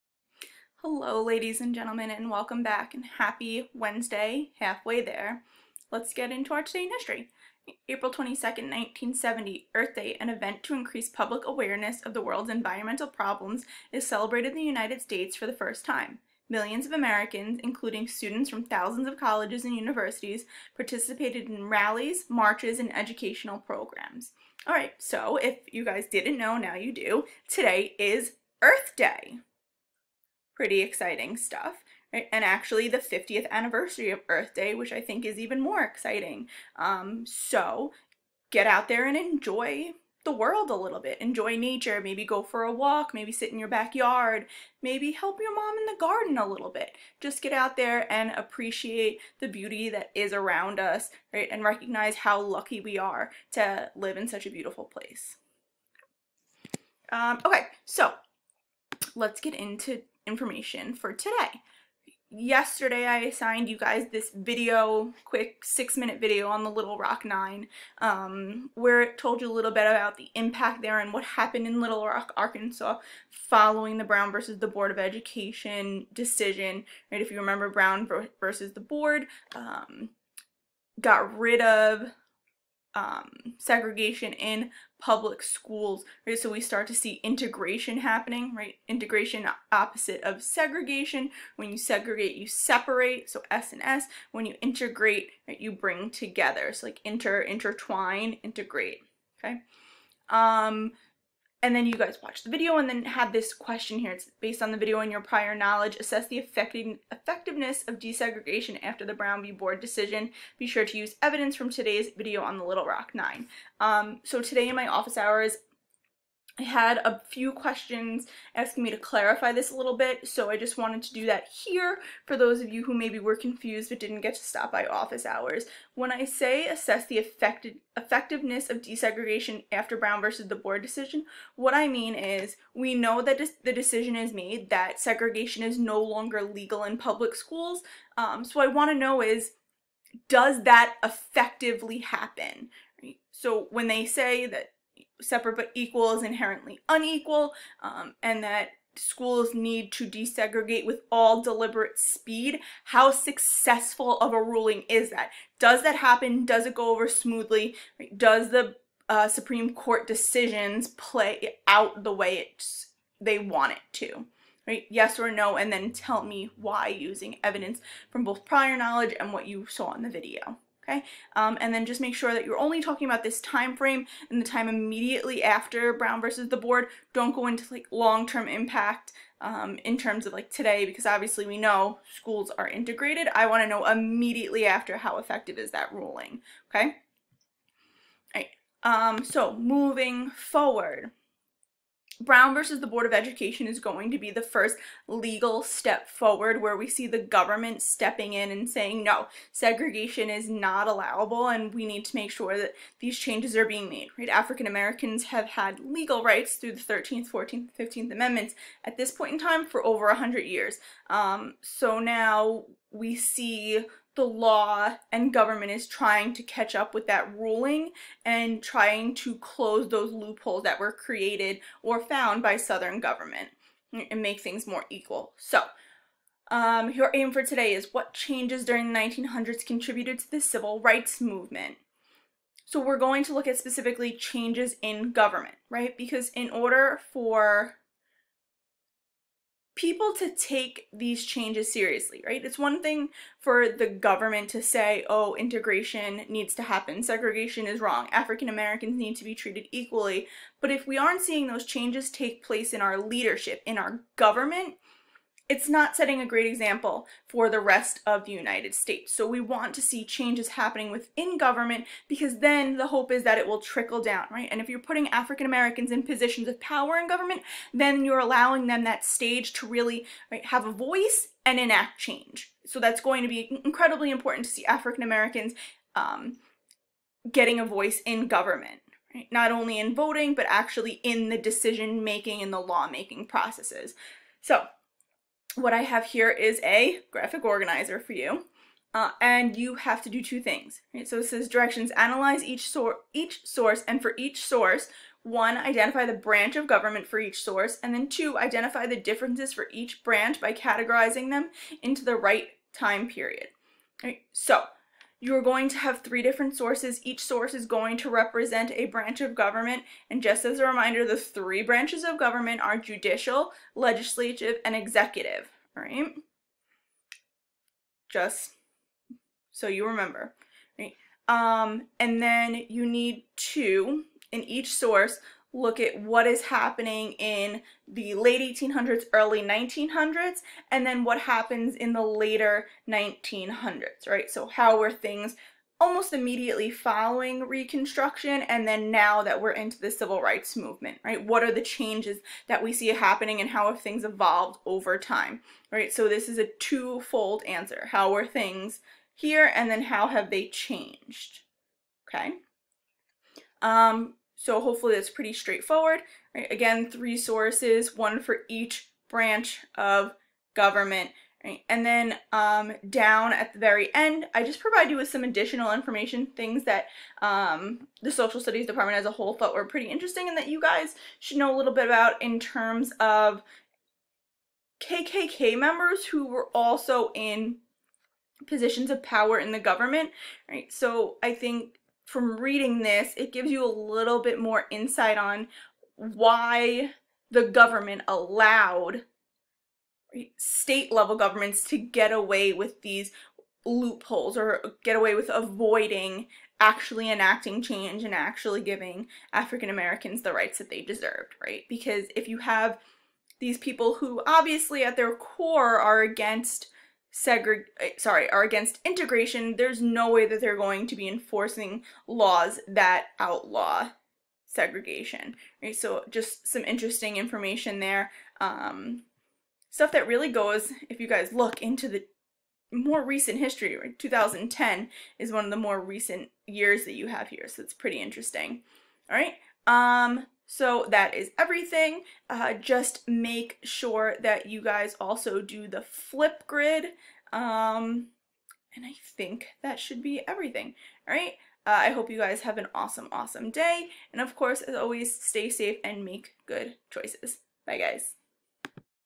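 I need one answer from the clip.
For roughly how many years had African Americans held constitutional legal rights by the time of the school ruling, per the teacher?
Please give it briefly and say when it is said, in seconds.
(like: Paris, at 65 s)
over 100 years, at 209 s.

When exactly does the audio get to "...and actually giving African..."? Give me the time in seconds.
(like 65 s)
398 s.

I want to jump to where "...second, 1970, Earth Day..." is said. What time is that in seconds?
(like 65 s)
8 s.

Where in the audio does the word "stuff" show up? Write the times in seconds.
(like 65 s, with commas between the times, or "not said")
31 s, 419 s.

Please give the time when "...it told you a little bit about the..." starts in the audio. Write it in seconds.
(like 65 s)
69 s.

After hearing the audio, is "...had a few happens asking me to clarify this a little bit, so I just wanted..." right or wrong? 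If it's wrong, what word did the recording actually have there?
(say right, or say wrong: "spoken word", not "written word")
wrong: "questions", not "happens".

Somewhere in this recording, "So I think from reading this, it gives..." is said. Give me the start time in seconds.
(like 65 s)
380 s.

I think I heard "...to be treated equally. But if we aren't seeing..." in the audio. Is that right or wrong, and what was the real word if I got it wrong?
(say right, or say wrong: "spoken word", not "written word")
right.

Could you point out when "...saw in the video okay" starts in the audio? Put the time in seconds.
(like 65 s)
169 s.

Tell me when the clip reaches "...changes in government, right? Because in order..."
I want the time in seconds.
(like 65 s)
234 s.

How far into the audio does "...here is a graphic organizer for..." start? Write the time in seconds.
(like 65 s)
286 s.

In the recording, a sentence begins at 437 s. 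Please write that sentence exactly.
Um, and I think that should be everything.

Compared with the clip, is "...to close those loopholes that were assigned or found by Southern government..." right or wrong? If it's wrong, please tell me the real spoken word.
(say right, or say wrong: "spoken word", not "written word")
wrong: "created", not "assigned".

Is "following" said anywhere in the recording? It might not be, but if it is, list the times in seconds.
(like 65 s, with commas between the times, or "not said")
73 s, 336 s.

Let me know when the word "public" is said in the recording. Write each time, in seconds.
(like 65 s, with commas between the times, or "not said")
11 s, 85 s, 136 s.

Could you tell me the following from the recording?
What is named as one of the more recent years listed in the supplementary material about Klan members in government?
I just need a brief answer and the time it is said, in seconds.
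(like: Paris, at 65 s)
2010, at 423 s.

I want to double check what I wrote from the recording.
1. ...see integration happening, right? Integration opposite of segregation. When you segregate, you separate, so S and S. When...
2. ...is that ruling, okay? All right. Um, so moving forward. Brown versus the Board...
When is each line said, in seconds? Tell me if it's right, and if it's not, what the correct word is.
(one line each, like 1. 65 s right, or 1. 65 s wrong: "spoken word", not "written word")
1. 86 s right
2. 185 s right.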